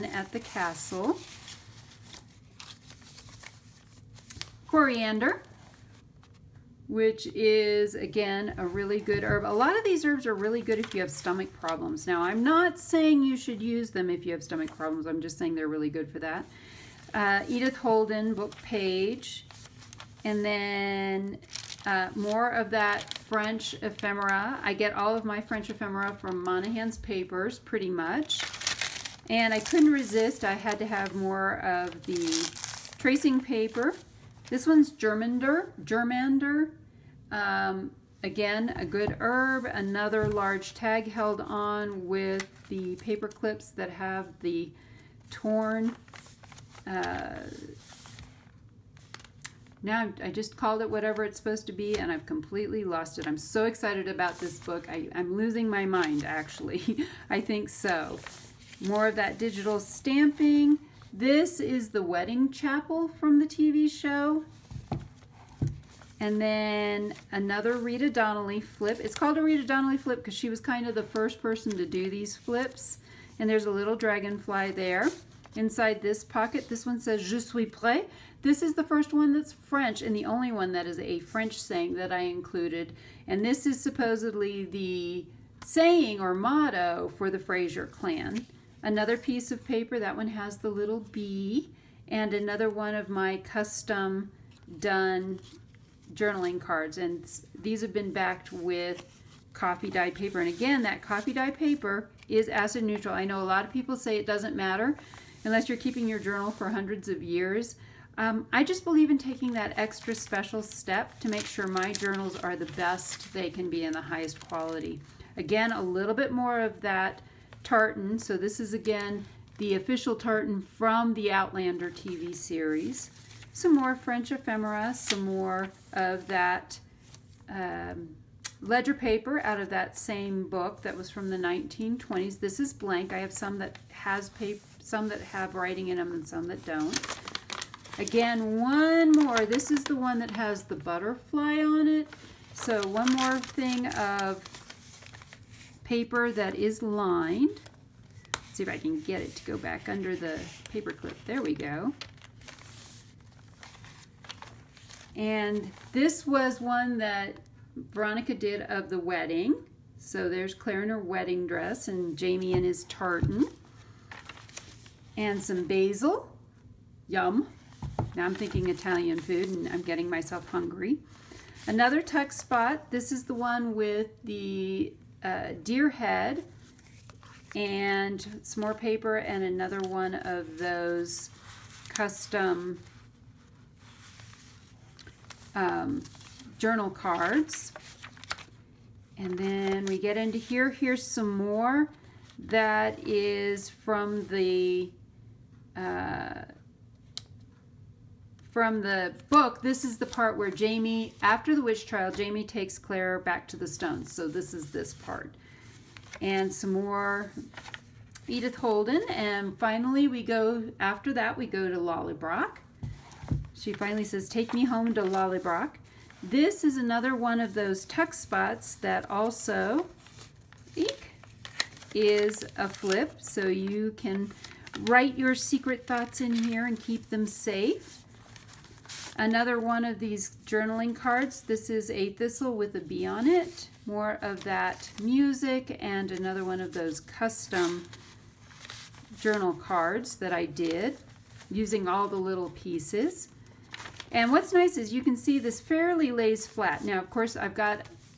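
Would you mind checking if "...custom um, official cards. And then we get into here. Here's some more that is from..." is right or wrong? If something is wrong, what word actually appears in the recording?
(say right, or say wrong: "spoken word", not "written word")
wrong: "journal", not "official".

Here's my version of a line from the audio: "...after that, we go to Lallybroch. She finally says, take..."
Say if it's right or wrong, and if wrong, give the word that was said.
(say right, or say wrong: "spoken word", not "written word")
right.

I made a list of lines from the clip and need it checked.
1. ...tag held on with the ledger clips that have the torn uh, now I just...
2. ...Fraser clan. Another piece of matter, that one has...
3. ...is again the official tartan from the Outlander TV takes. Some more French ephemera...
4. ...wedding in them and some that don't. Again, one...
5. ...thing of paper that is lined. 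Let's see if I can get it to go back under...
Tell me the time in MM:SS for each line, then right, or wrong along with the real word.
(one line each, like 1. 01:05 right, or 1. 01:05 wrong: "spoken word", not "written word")
1. 00:40 wrong: "paper", not "ledger"
2. 01:27 wrong: "paper", not "matter"
3. 01:58 wrong: "series", not "takes"
4. 02:15 wrong: "writing", not "wedding"
5. 02:23 right.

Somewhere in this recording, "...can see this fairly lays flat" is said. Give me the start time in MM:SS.
04:05.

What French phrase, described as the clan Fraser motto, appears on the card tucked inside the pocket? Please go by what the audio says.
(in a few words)
Je suis prêt.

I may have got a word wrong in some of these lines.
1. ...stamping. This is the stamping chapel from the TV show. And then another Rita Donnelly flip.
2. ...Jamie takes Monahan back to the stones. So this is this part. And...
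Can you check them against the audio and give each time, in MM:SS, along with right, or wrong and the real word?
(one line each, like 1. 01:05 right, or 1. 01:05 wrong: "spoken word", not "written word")
1. 00:59 wrong: "wedding", not "stamping"
2. 03:22 wrong: "Claire", not "Monahan".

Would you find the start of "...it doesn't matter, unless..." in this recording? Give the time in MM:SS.
01:44.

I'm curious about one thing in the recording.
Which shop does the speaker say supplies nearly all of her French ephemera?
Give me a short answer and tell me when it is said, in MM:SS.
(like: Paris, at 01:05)
Monahan's papers, at 00:26.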